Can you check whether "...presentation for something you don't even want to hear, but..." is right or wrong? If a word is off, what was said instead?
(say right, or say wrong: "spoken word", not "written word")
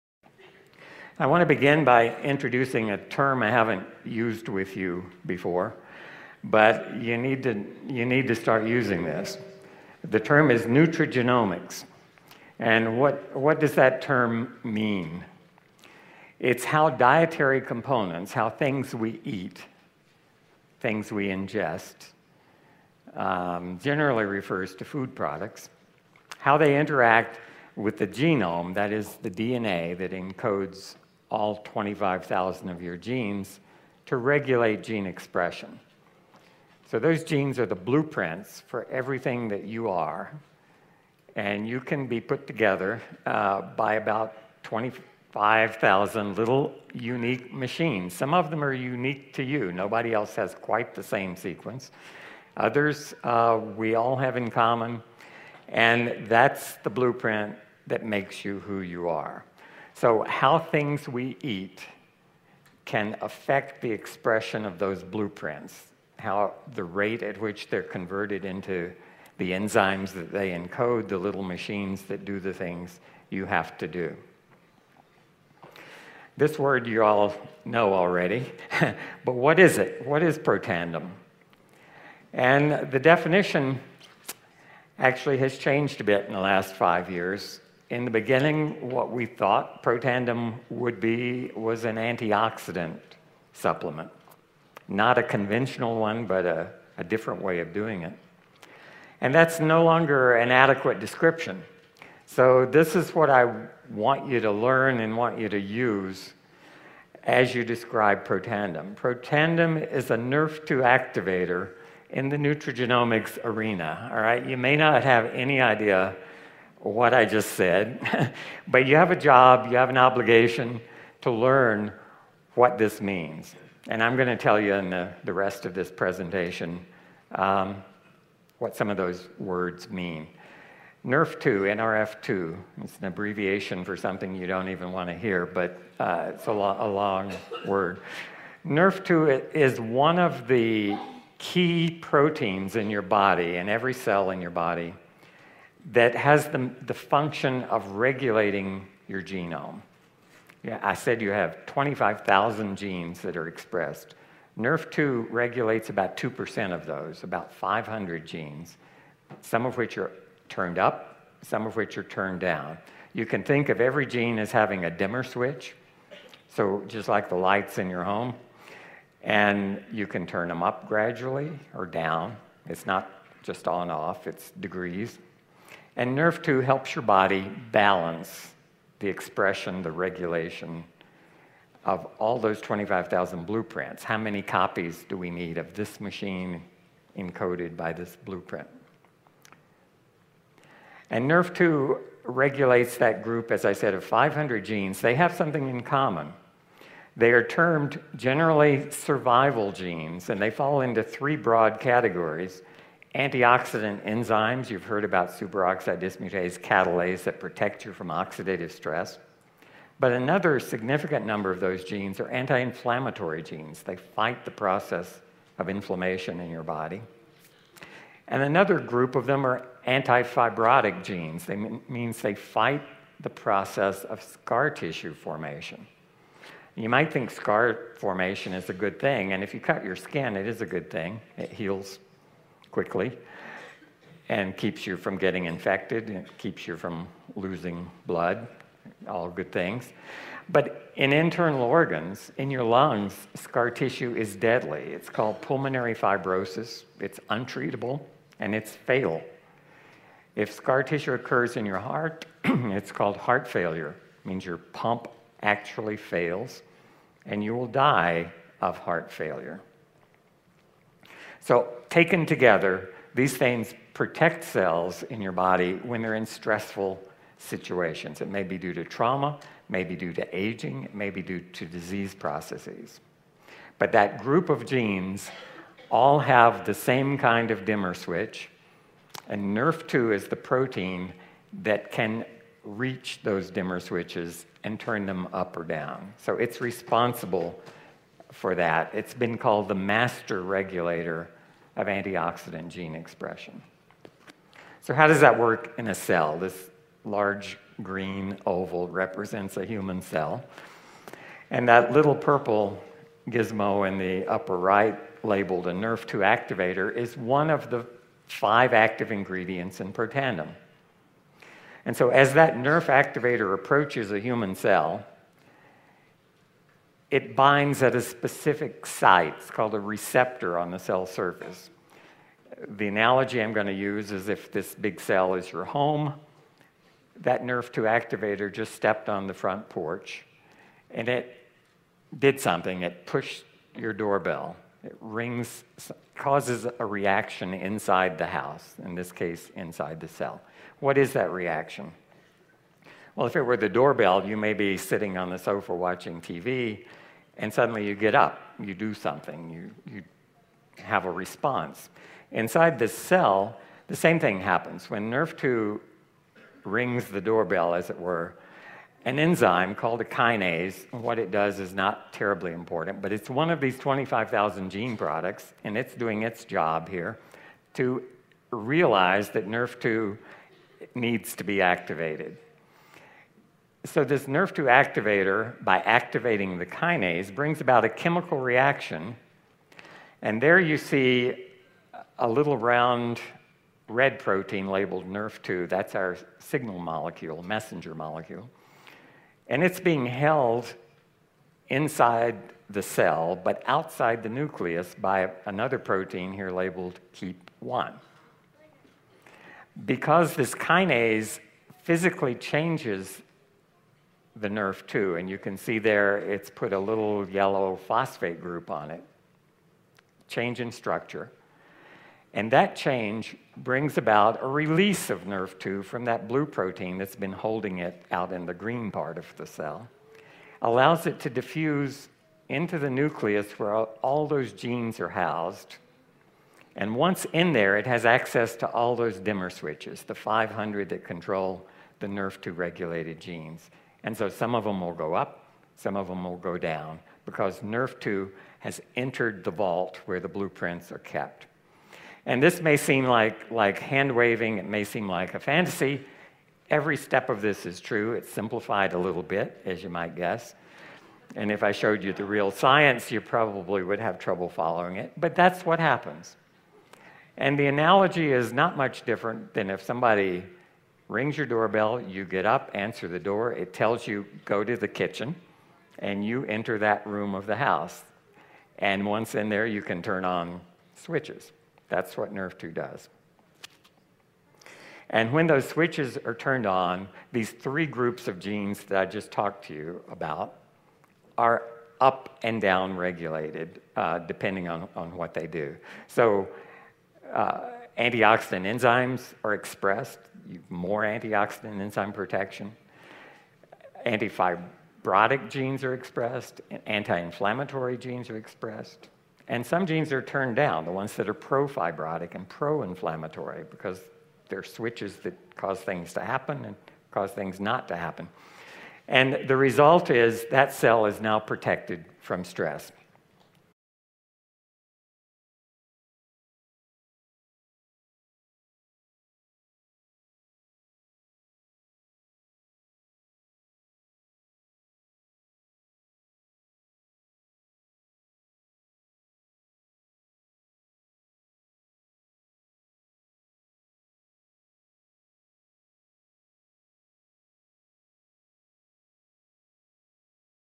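wrong: "abbreviation", not "presentation".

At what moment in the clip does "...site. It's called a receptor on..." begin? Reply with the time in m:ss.
5:18.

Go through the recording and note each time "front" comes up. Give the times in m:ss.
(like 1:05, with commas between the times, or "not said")
5:29.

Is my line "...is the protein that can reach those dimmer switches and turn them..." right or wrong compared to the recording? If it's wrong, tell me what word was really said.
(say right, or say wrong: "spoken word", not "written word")
right.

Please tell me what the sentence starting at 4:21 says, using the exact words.
So, taken together, these things protect cells in your body when they're in stressful situations.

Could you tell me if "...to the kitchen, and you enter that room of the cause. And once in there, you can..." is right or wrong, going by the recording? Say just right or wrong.
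wrong.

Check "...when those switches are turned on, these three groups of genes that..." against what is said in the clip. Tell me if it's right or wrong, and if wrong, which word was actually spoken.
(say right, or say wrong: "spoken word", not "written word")
right.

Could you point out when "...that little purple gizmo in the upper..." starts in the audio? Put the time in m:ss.
5:01.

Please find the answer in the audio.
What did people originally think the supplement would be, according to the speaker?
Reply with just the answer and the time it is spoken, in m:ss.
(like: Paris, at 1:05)
antioxidant supplement, at 1:31.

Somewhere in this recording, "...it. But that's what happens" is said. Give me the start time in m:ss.
7:34.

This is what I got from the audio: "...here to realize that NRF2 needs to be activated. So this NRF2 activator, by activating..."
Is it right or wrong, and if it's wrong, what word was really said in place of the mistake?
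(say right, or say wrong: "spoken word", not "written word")
right.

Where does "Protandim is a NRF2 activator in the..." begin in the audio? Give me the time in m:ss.
1:48.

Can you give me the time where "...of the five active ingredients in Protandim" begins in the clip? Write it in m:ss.
5:07.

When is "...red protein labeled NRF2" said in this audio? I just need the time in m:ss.
6:23.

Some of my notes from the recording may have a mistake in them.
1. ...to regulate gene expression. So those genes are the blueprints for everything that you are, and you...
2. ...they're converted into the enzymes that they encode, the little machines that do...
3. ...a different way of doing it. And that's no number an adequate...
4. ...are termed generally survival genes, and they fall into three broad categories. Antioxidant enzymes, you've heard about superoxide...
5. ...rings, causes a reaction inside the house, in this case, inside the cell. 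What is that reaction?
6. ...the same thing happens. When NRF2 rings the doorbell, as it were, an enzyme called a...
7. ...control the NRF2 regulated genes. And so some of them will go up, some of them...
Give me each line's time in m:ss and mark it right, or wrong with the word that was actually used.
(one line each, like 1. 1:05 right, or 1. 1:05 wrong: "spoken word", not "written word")
1. 0:34 right
2. 1:07 right
3. 1:36 wrong: "longer", not "number"
4. 3:17 right
5. 5:35 right
6. 5:53 right
7. 7:11 right.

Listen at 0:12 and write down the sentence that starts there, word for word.
And what, what does that term mean?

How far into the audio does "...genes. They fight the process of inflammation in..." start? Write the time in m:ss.
3:33.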